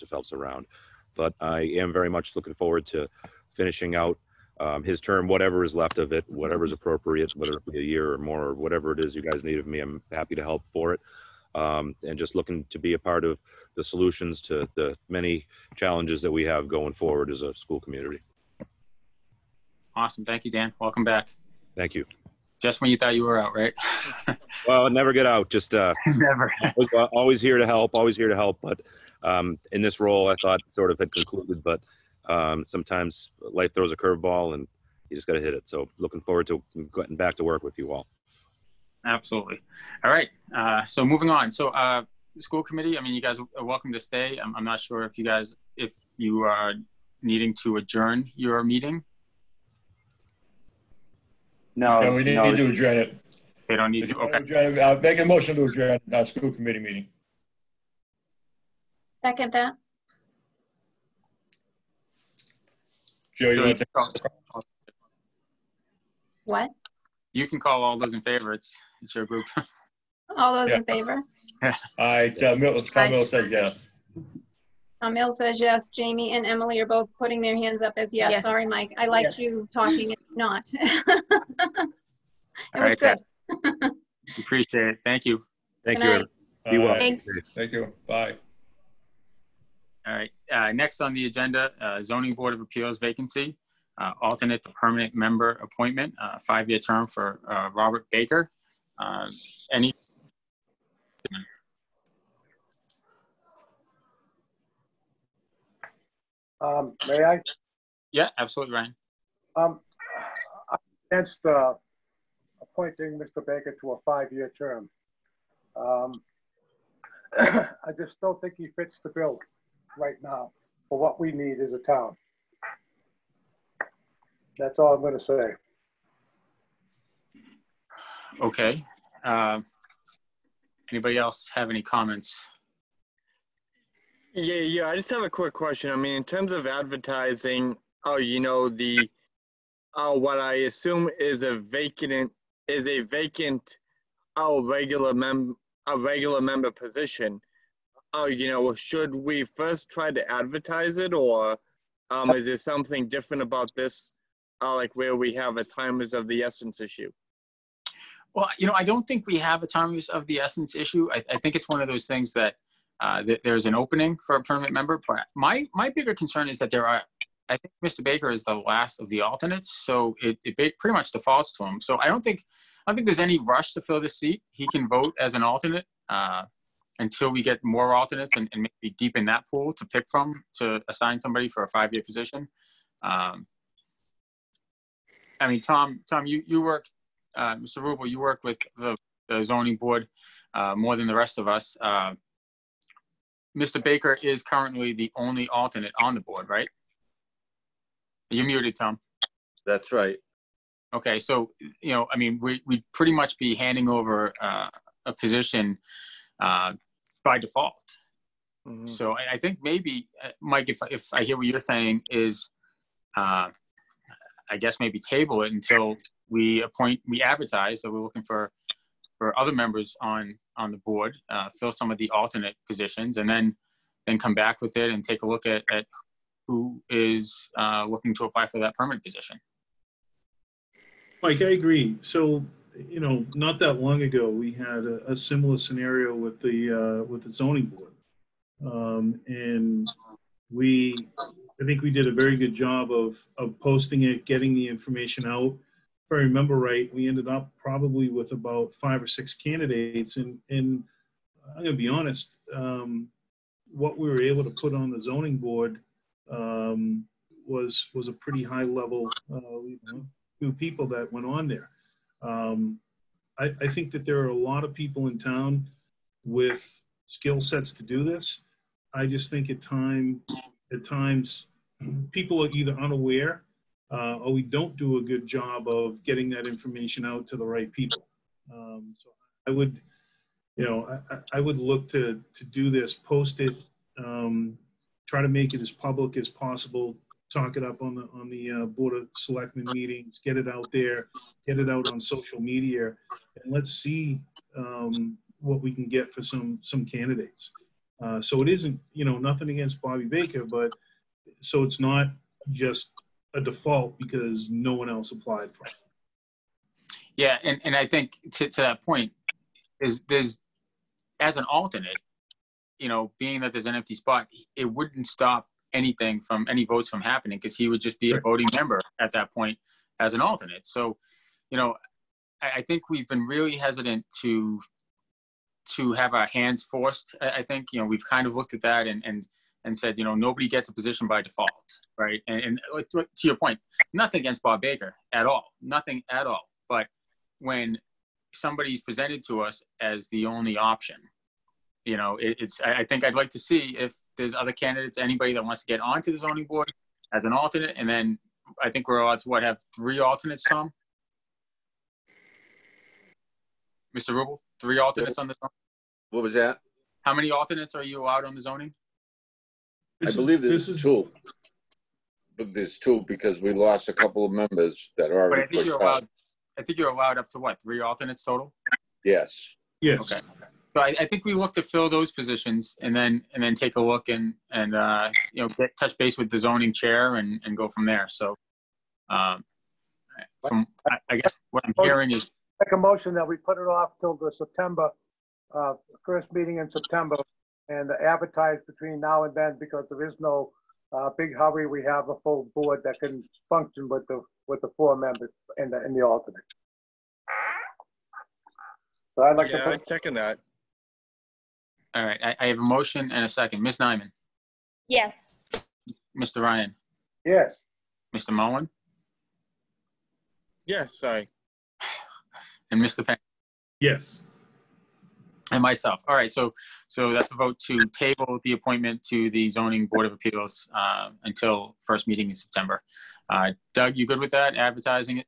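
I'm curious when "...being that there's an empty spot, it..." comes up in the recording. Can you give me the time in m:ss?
5:13.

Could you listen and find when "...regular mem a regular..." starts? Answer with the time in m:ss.
2:24.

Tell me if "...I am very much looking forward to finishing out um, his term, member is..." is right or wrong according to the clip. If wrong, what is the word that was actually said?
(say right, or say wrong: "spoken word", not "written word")
wrong: "whatever", not "member".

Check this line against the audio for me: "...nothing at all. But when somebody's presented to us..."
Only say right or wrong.
right.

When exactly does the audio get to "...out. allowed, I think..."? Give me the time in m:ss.
6:05.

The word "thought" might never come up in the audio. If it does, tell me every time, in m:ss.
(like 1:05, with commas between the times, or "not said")
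0:22, 0:30.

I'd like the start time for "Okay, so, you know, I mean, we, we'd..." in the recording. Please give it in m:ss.
3:20.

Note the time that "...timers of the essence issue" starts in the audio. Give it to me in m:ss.
2:39.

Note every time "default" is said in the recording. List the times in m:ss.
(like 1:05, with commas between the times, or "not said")
2:51, 3:27, 5:03, 5:31.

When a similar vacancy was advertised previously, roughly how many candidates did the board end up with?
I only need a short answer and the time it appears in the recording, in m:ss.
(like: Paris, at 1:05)
5 or 6, at 4:08.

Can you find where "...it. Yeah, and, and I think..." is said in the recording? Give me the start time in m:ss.
5:05.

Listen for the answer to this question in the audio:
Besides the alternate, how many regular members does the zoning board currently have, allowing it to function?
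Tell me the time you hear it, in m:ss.
6:34.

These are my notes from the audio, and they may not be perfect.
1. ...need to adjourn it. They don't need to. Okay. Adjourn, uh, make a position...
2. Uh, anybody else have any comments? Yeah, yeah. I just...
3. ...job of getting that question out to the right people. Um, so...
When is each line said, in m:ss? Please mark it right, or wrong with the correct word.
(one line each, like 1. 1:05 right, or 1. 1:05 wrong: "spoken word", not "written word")
1. 0:52 wrong: "motion", not "position"
2. 2:09 right
3. 4:35 wrong: "information", not "question".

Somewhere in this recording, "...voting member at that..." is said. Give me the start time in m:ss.
5:18.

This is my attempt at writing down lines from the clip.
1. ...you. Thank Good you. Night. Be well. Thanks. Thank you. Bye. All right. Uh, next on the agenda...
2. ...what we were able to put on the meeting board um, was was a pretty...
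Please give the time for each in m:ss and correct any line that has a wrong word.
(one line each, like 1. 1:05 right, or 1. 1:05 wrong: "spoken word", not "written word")
1. 1:25 right
2. 4:13 wrong: "zoning", not "meeting".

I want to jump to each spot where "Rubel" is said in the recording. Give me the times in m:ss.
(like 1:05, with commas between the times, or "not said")
3:07, 5:54.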